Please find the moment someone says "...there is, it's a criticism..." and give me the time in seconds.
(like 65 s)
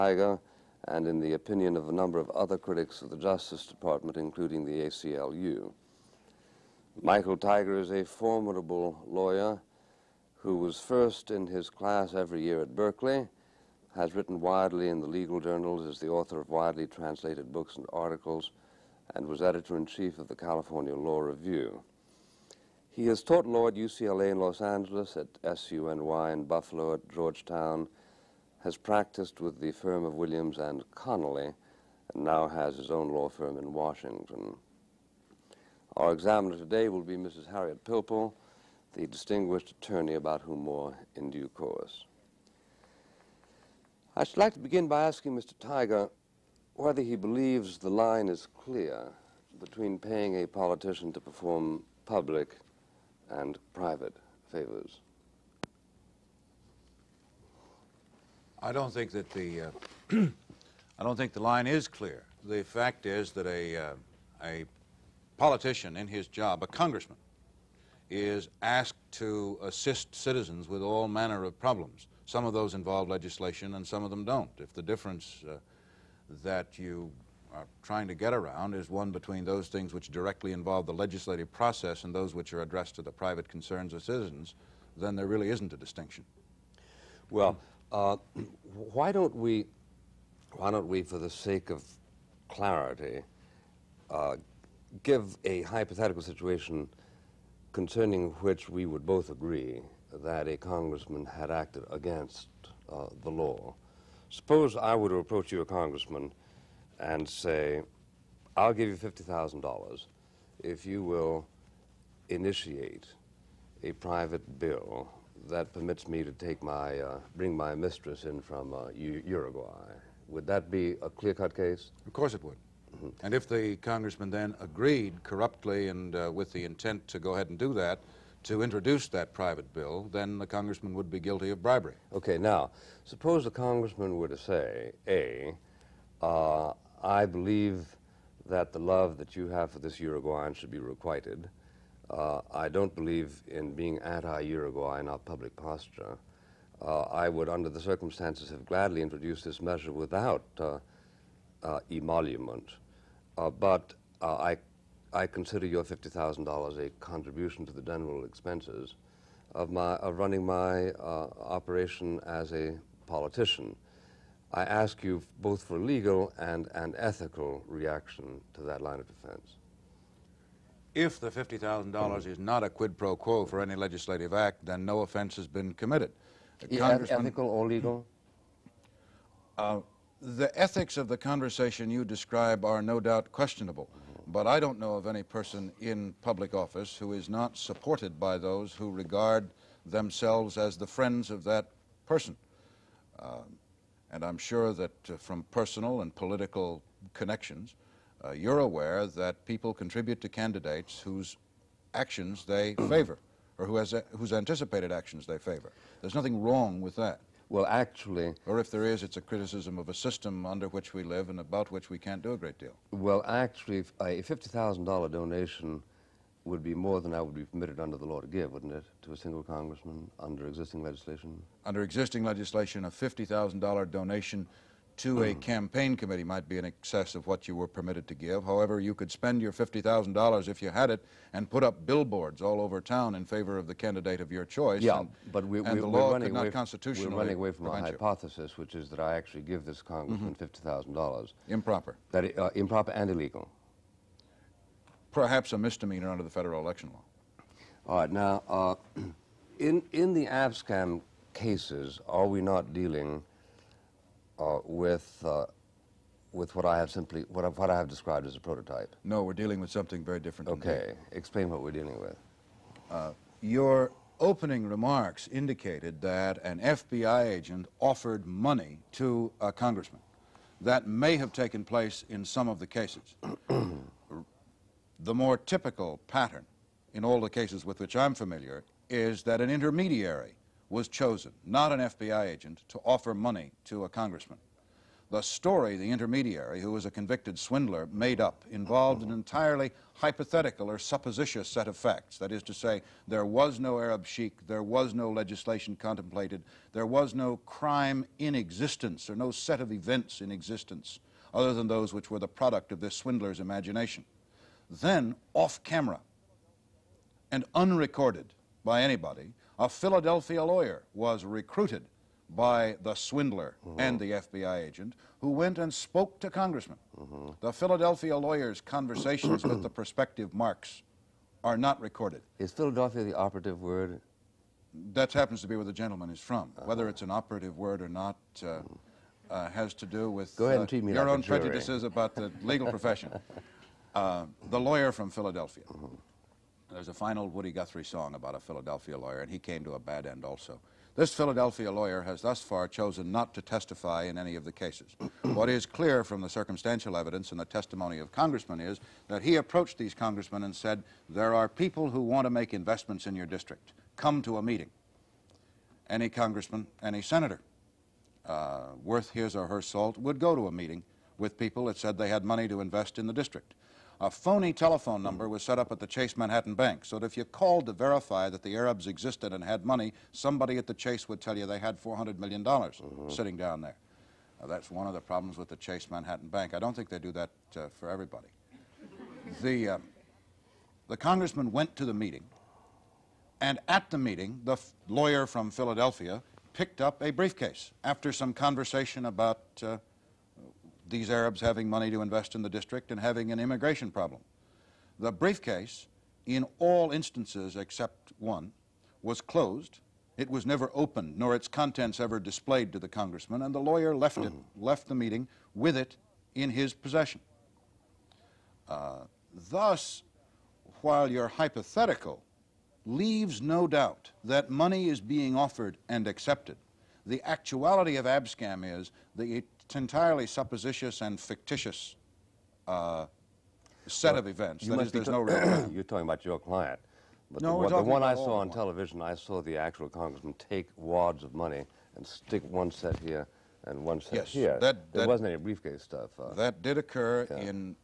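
208 s.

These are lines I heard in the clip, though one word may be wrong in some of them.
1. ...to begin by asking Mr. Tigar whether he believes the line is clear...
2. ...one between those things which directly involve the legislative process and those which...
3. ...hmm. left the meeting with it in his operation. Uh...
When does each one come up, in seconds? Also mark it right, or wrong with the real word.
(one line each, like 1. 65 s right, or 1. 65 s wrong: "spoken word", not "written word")
1. 44 s right
2. 78 s right
3. 404 s wrong: "possession", not "operation".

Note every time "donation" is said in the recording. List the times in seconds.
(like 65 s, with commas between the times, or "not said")
215 s, 223 s.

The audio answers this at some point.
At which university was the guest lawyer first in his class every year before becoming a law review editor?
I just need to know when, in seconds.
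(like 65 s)
12 s.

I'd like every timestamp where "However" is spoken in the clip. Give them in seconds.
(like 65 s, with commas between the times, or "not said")
228 s.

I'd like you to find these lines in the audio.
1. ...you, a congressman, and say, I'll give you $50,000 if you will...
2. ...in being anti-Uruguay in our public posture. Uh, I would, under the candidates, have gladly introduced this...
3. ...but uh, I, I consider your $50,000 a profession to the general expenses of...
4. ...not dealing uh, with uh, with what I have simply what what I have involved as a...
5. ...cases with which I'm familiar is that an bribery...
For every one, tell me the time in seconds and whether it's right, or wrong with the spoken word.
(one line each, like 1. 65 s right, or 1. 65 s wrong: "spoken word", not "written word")
1. 105 s right
2. 143 s wrong: "circumstances", not "candidates"
3. 153 s wrong: "contribution", not "profession"
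4. 252 s wrong: "described", not "involved"
5. 277 s wrong: "intermediary", not "bribery".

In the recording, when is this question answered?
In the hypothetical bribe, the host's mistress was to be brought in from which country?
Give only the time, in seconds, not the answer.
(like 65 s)
118 s.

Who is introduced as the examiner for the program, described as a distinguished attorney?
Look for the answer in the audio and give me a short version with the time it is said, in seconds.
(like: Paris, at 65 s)
Harriet Pilpel, at 37 s.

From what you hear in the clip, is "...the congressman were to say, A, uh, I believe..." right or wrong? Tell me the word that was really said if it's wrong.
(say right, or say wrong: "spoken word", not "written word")
right.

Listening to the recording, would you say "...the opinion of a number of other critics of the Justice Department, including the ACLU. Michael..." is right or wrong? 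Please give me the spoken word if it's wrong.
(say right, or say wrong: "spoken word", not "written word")
right.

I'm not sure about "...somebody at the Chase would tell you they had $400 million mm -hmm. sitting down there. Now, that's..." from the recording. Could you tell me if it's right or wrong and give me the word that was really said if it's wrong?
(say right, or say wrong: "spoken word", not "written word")
right.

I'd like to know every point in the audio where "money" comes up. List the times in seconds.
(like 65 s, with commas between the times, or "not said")
268 s, 283 s, 362 s, 369 s, 391 s, 414 s, 431 s.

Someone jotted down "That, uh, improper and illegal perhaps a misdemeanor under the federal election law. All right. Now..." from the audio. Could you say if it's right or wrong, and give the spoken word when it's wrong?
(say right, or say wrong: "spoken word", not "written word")
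right.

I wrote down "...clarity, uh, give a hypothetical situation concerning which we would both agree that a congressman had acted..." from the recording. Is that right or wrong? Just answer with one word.
right.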